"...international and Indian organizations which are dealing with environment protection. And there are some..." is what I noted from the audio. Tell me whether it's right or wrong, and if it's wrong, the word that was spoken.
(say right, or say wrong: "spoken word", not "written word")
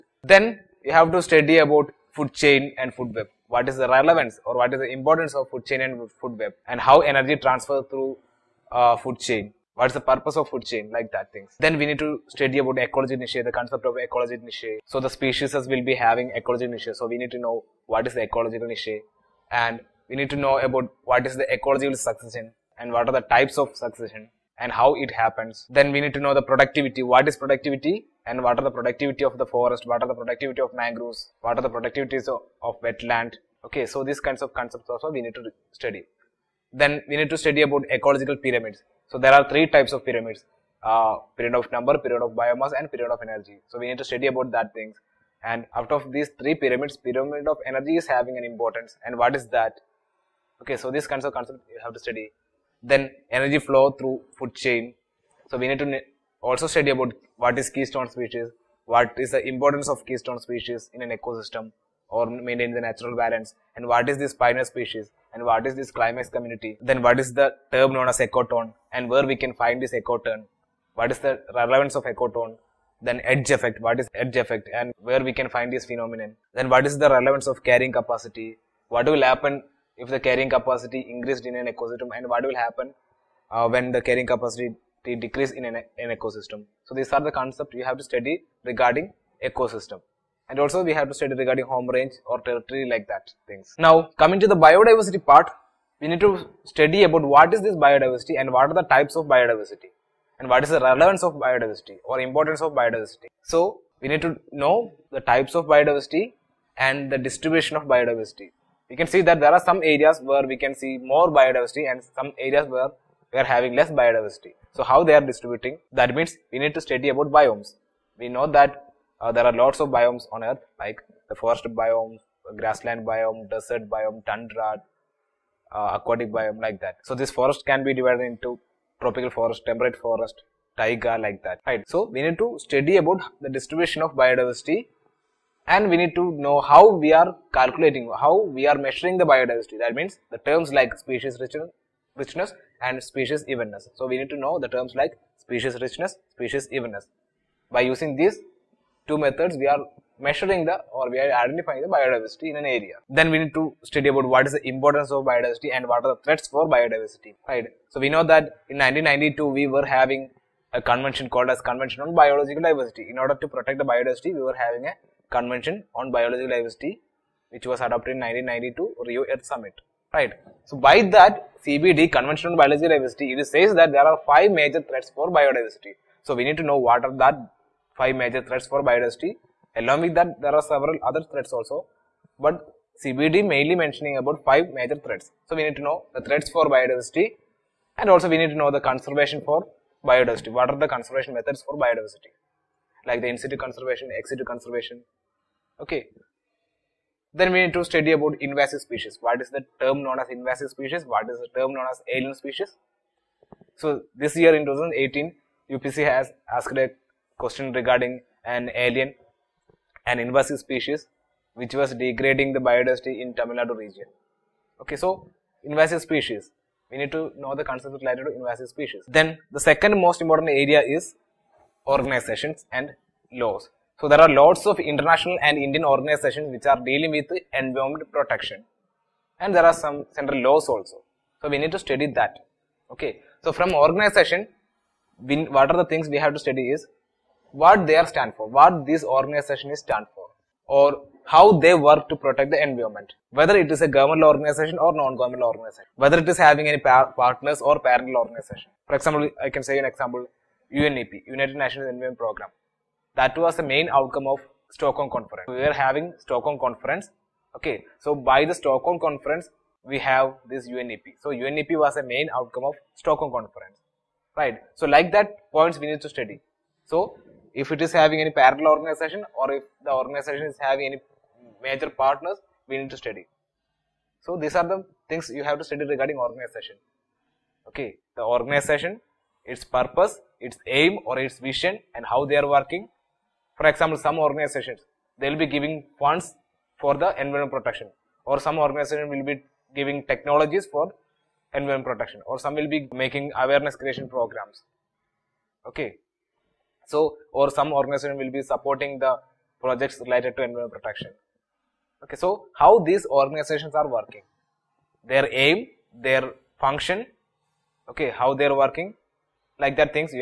right.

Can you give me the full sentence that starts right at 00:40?
Uh, pyramid of number, pyramid of biomass and pyramid of energy.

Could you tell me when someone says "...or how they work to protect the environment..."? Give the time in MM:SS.
04:00.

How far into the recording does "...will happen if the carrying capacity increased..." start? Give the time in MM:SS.
01:19.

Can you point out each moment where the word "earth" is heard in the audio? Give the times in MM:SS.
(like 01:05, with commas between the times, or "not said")
02:00, 02:49.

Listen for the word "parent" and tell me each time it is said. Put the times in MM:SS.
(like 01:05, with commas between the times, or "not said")
04:07.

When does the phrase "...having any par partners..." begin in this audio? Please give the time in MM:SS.
04:06.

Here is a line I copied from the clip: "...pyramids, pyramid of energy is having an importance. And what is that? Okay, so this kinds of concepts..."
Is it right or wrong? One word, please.
right.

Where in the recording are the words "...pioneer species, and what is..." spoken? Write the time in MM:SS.
01:04.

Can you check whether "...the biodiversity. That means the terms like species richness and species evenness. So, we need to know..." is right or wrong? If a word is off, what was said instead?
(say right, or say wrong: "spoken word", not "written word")
right.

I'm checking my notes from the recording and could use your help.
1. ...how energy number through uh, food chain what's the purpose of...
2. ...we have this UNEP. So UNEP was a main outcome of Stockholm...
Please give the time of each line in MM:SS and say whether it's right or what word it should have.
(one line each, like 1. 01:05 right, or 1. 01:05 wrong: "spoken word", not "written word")
1. 00:06 wrong: "transfer", not "number"
2. 04:19 right.